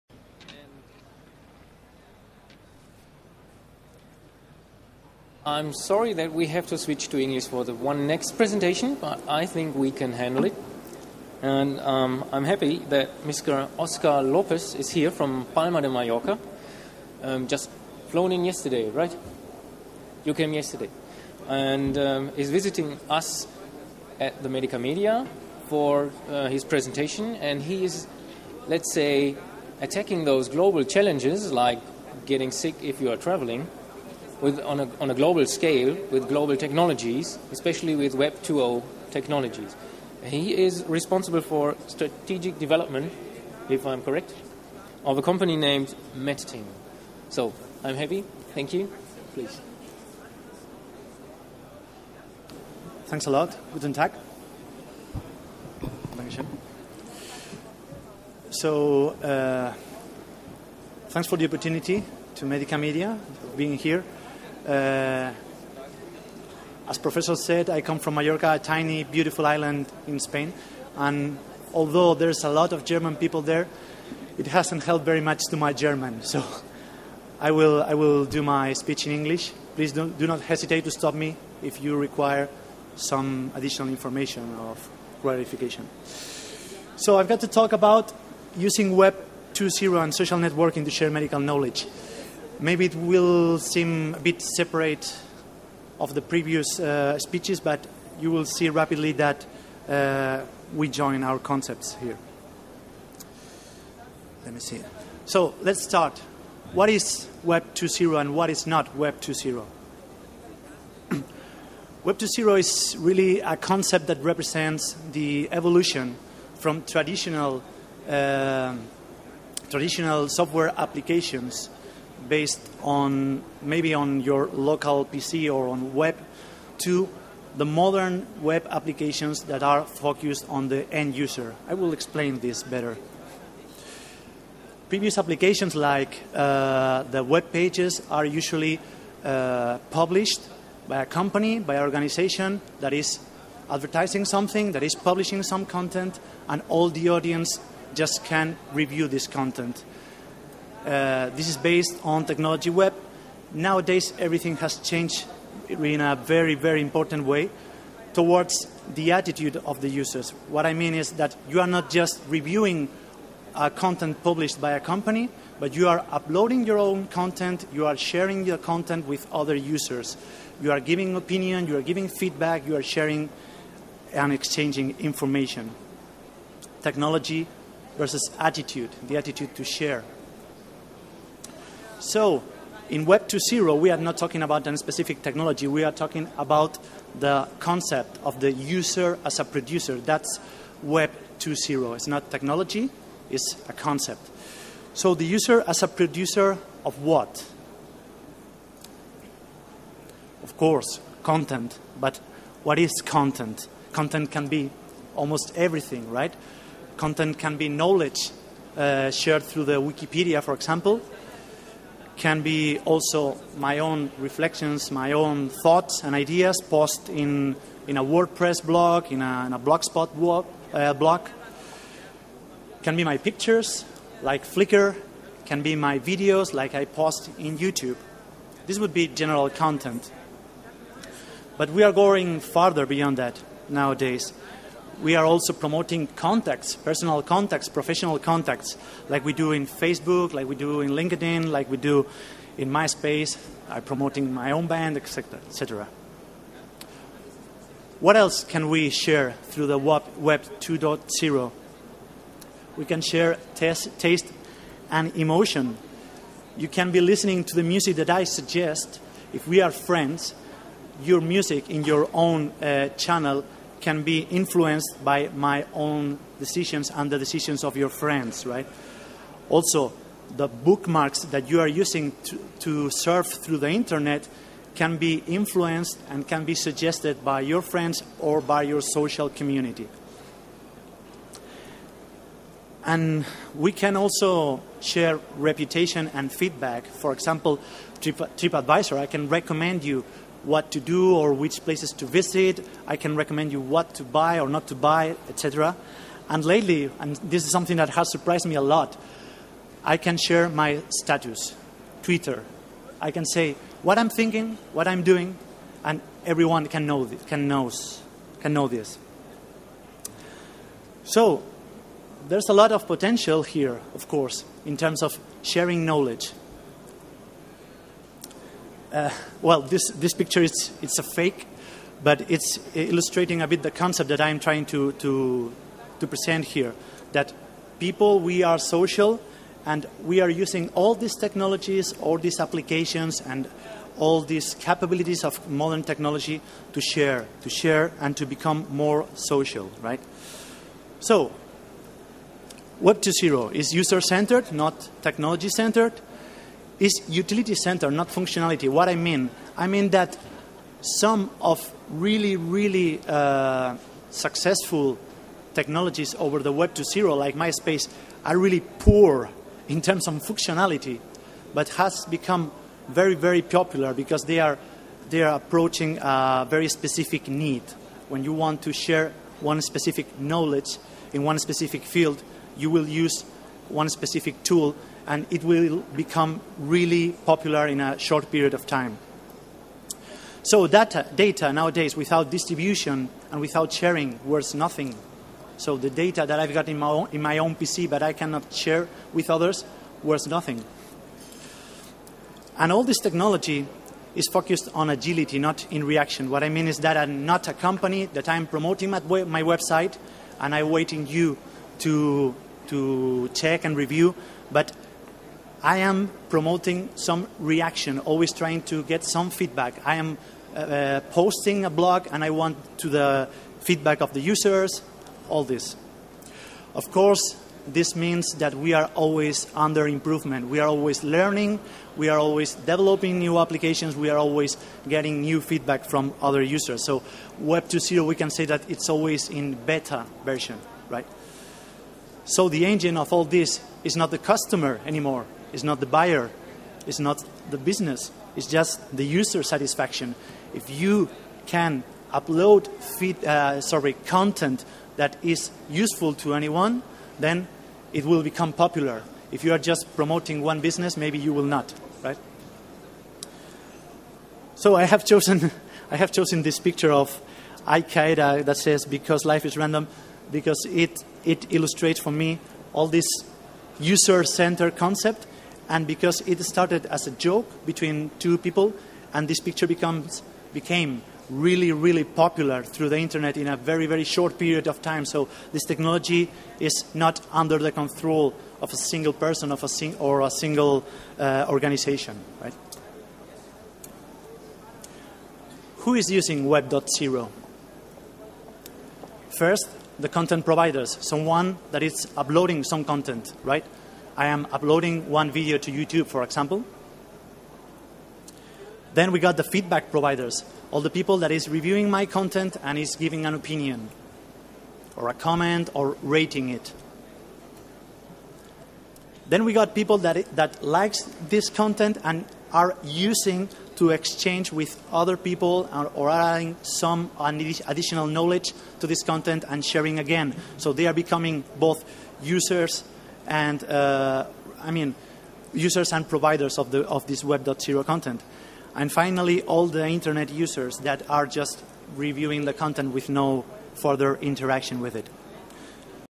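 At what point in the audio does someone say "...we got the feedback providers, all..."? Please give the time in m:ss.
8:19.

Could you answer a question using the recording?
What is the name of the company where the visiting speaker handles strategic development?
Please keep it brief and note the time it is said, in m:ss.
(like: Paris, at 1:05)
MetaTeam, at 0:46.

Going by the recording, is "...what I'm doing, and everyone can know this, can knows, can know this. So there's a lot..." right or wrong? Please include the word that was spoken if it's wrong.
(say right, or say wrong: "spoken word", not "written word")
right.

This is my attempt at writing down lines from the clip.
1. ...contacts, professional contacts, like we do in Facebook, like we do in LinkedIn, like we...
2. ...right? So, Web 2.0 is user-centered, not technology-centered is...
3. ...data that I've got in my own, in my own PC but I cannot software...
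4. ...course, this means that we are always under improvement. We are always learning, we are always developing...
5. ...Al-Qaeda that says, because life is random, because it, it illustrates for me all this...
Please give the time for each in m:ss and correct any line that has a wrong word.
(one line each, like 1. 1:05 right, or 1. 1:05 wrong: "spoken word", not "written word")
1. 3:57 right
2. 5:39 right
3. 6:25 wrong: "share", not "software"
4. 6:56 right
5. 7:37 right.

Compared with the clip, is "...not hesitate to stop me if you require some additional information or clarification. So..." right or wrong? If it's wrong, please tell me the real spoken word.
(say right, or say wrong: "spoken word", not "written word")
right.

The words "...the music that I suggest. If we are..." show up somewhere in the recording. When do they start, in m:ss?
4:17.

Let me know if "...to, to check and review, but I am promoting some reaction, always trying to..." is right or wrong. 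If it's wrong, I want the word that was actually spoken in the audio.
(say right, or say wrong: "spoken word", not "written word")
right.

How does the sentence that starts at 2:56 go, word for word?
Technology versus attitude, the attitude to share.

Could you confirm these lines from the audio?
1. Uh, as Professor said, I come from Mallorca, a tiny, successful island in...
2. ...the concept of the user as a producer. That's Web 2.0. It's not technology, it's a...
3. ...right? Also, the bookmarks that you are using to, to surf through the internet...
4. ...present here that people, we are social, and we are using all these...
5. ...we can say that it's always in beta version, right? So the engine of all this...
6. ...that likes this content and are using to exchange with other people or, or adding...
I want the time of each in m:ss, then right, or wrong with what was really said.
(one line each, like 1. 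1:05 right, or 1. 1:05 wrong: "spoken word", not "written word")
1. 1:04 wrong: "beautiful", not "successful"
2. 3:07 right
3. 4:28 right
4. 5:26 right
5. 7:08 right
6. 8:30 right.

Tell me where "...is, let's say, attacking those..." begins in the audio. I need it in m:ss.
0:27.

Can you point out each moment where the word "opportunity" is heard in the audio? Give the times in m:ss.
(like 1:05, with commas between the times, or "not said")
1:01.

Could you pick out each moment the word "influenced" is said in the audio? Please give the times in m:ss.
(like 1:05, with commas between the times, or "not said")
4:24, 4:35.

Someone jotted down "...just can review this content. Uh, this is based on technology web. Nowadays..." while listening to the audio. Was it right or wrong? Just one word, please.
right.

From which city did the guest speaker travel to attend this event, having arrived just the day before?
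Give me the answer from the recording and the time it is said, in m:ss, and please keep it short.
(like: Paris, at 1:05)
Palma de Mallorca, at 0:15.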